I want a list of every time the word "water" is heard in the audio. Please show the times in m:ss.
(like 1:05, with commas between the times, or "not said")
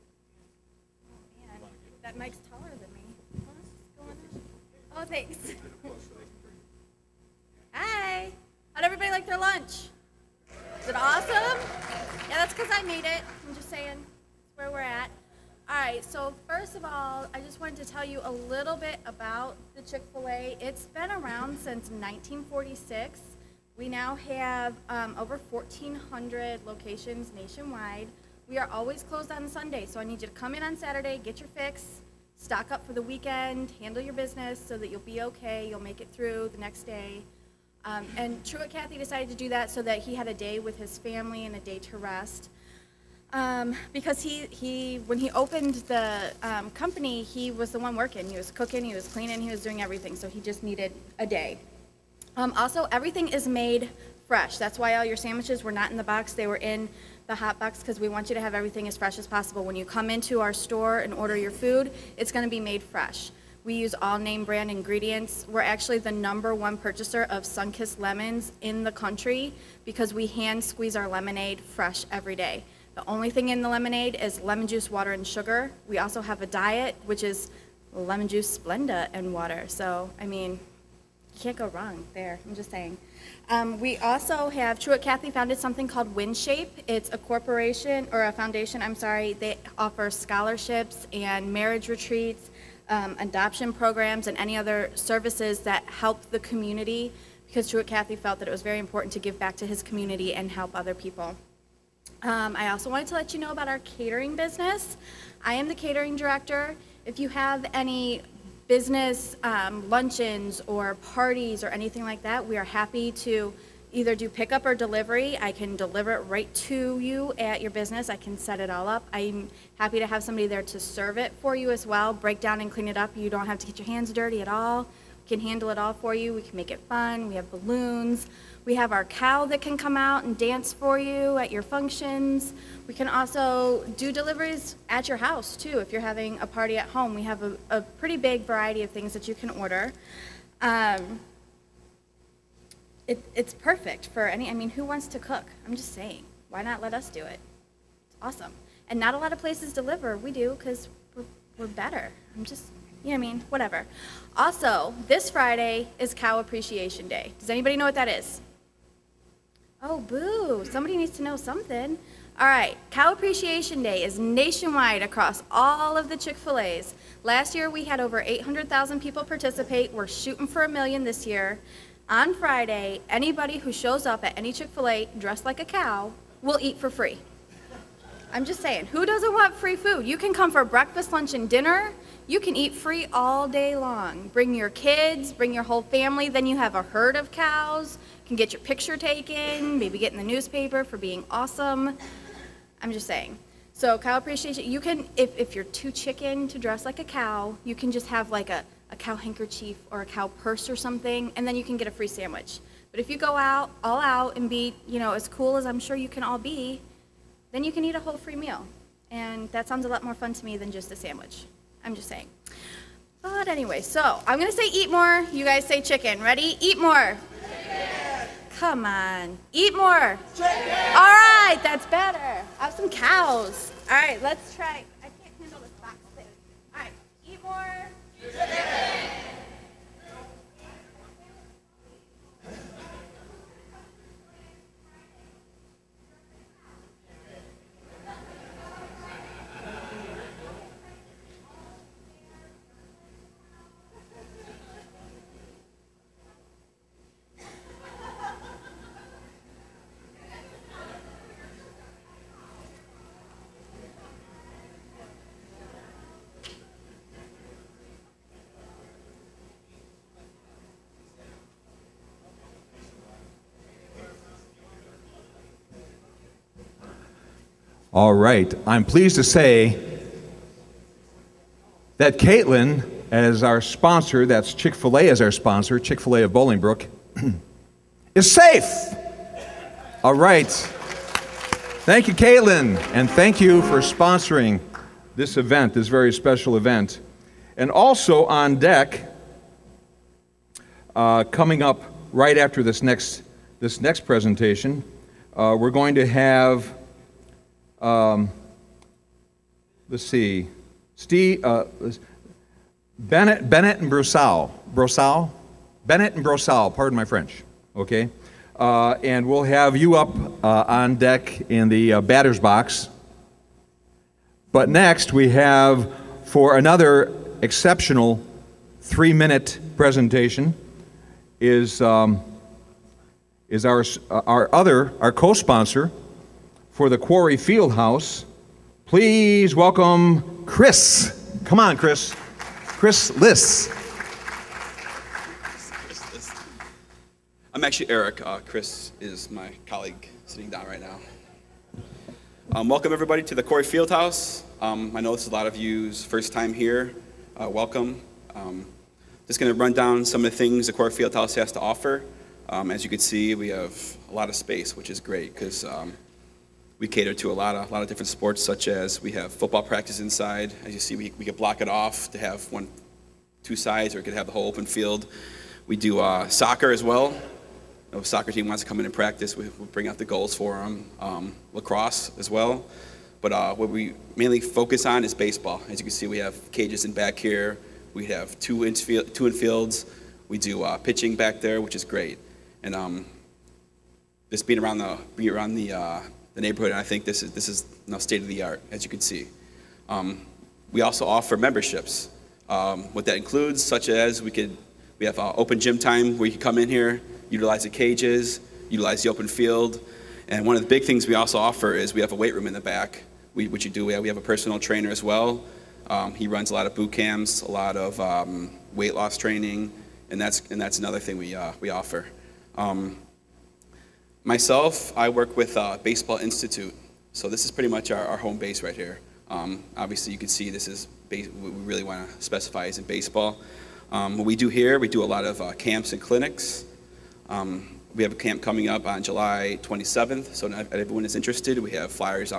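1:14, 1:19.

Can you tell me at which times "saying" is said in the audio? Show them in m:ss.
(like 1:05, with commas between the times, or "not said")
0:13, 1:22, 2:25, 2:58, 3:13, 3:32.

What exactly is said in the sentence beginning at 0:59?
When you come into our store and order your food, it's going to be made fresh.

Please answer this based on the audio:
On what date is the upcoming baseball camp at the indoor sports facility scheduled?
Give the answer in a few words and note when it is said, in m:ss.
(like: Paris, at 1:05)
July 27, at 7:09.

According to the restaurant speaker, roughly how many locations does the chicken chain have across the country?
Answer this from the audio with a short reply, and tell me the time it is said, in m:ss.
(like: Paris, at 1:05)
over 1,400, at 0:25.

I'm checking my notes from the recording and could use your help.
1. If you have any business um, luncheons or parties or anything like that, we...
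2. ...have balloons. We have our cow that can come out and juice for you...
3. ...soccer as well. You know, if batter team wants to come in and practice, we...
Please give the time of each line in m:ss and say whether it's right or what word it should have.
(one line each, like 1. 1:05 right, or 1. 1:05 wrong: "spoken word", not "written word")
1. 1:47 right
2. 2:07 wrong: "dance", not "juice"
3. 6:06 wrong: "soccer", not "batter".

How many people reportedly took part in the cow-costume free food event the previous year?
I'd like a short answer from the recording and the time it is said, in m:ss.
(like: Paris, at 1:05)
over 800,000, at 2:47.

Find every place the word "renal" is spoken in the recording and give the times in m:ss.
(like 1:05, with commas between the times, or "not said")
not said.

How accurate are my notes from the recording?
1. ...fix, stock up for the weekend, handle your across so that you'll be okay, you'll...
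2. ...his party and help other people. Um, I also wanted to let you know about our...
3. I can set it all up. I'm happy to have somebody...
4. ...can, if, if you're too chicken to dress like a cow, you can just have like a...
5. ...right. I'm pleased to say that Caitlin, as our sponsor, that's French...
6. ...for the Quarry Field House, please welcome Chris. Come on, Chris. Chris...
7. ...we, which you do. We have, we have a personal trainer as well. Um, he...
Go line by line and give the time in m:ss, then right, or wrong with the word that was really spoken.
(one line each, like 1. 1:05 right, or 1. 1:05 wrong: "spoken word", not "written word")
1. 0:31 wrong: "business", not "across"
2. 1:39 wrong: "community", not "party"
3. 1:58 right
4. 3:14 right
5. 4:28 wrong: "Chick", not "French"
6. 5:26 right
7. 6:43 right.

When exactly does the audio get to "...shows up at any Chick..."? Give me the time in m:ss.
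2:53.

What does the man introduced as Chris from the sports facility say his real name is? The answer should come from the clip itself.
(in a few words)
Eric.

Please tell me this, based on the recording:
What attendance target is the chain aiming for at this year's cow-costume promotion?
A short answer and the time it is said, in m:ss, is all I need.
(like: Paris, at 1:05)
1 million, at 2:50.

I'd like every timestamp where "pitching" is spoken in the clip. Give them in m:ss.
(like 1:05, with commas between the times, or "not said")
6:20.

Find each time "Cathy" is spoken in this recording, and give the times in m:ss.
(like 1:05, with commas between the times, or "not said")
0:38, 1:25, 1:37.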